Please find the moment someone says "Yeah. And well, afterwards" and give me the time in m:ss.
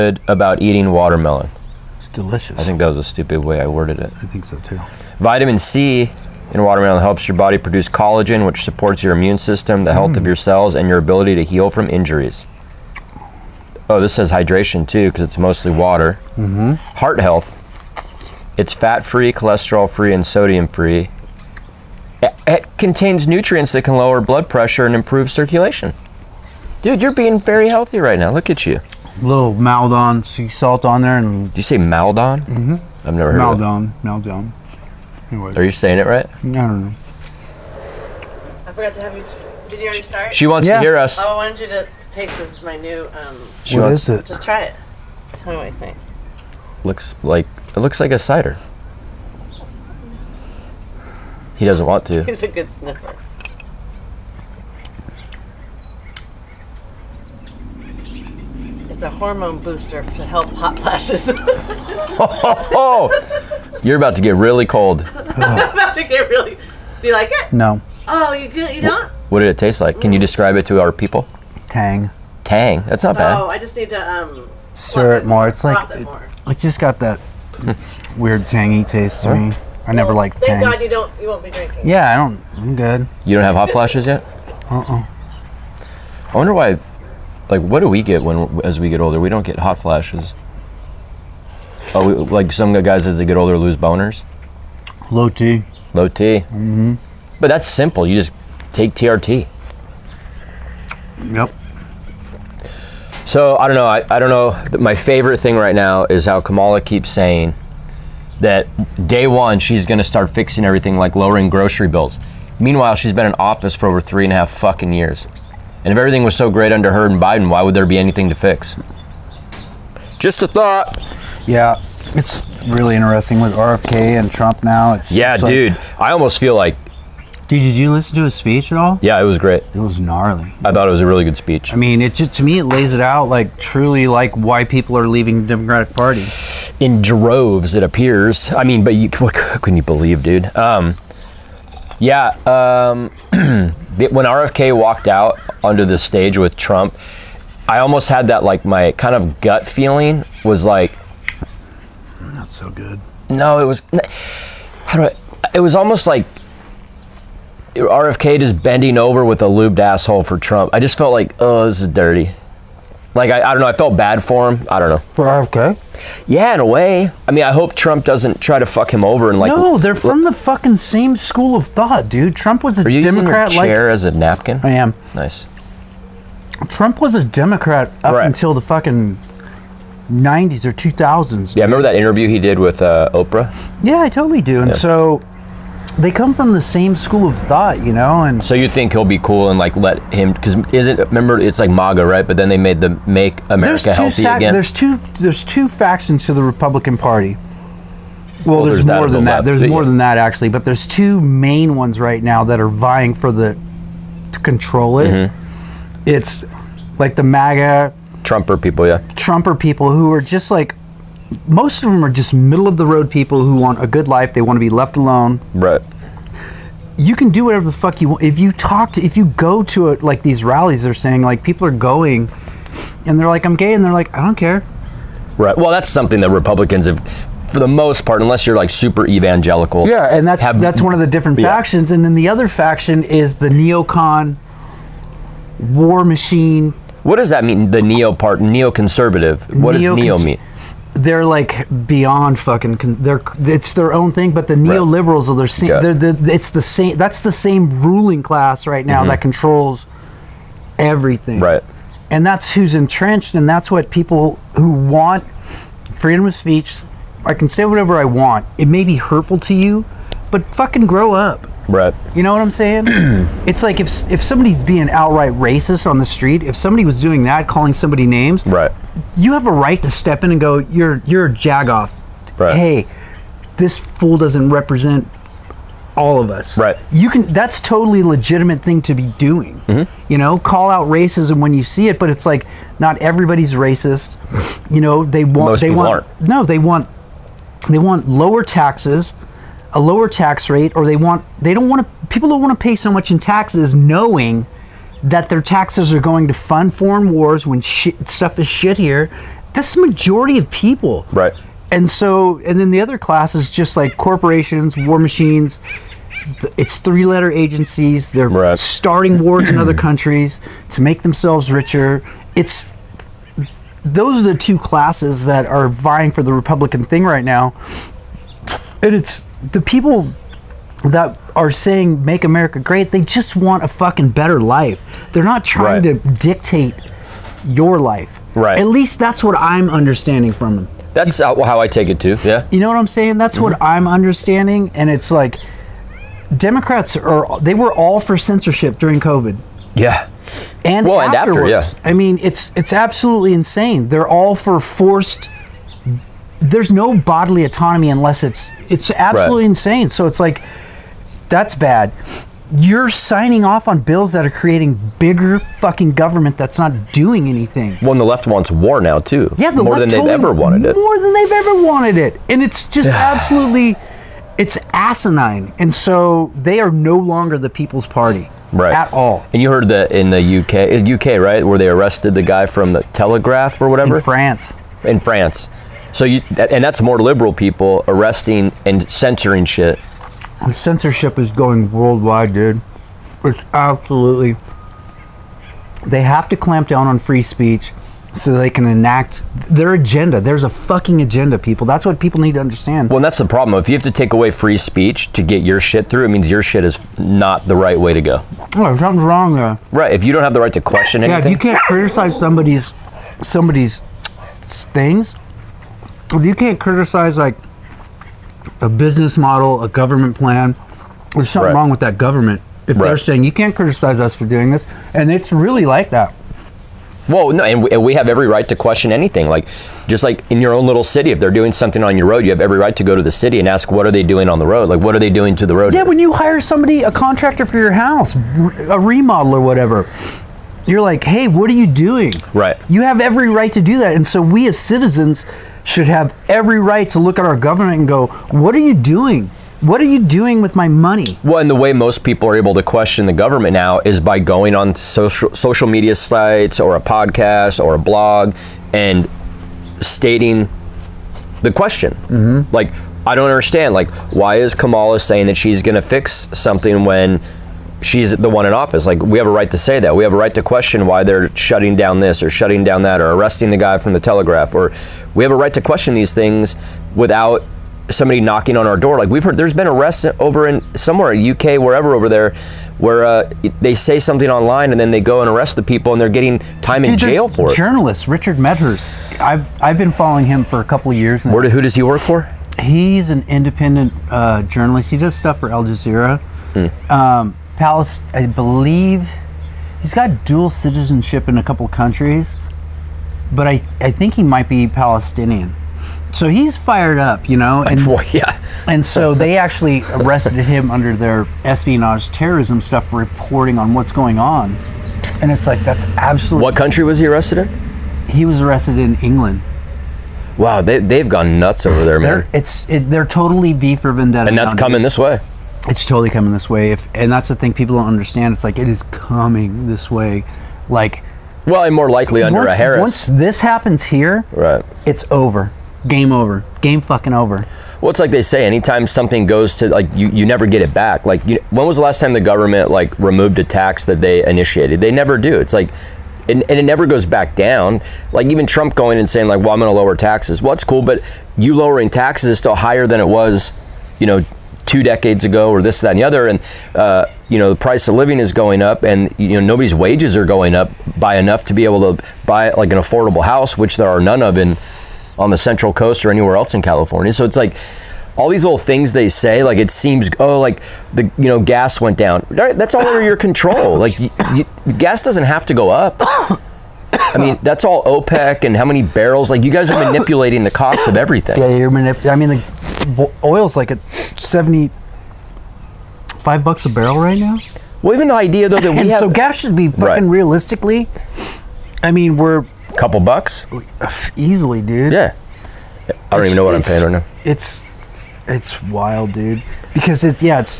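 5:39.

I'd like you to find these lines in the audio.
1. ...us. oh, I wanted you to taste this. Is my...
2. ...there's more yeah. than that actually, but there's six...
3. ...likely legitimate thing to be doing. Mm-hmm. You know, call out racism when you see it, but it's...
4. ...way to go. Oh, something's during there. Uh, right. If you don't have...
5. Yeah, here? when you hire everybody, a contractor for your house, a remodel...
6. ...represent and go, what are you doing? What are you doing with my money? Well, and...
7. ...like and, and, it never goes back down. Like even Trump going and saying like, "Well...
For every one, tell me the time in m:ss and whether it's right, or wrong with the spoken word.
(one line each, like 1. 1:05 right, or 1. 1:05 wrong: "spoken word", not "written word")
1. 0:40 right
2. 3:19 wrong: "two", not "six"
3. 4:37 wrong: "totally", not "likely"
4. 6:37 wrong: "wrong", not "during"
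5. 7:05 wrong: "somebody", not "everybody"
6. 7:17 wrong: "government", not "represent"
7. 8:55 right.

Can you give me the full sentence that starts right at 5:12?
It's those are the two classes that are vying for the Republican thing right now.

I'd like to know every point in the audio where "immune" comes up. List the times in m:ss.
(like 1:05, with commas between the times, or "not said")
0:09.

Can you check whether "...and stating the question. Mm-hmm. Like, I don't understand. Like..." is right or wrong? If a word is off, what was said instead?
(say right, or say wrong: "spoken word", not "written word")
right.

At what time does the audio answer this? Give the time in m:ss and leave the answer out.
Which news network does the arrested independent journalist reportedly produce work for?
8:05.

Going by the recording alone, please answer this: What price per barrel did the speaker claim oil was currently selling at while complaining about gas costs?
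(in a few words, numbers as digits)
75 dollars.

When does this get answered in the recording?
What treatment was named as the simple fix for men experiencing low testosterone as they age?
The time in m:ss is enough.
1:38.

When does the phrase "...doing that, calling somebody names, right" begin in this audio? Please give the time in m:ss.
4:27.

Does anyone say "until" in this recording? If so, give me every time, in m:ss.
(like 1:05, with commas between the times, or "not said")
2:58.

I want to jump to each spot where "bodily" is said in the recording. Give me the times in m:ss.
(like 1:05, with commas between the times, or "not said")
5:46.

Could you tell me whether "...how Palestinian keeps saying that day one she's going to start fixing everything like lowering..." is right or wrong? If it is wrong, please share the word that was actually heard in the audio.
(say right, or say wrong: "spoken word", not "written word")
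wrong: "Kamala", not "Palestinian".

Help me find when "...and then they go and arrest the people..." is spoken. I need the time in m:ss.
7:54.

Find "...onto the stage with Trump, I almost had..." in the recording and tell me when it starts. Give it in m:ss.
2:25.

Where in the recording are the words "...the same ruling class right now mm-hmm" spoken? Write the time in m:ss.
4:07.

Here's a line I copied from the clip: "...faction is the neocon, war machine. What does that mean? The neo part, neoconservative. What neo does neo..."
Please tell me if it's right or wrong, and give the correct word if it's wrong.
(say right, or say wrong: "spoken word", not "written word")
right.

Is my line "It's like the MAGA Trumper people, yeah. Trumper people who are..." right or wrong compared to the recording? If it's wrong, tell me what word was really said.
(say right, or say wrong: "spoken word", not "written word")
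right.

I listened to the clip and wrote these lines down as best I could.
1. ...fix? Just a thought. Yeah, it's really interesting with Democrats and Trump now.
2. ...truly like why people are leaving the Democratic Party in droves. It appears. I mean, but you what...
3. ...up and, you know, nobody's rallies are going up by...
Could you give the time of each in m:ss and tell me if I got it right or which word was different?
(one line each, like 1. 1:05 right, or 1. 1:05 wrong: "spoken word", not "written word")
1. 1:58 wrong: "RFK", not "Democrats"
2. 2:13 right
3. 9:08 wrong: "wages", not "rallies".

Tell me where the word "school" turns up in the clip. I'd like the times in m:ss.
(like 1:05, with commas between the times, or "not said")
2:51, 3:06.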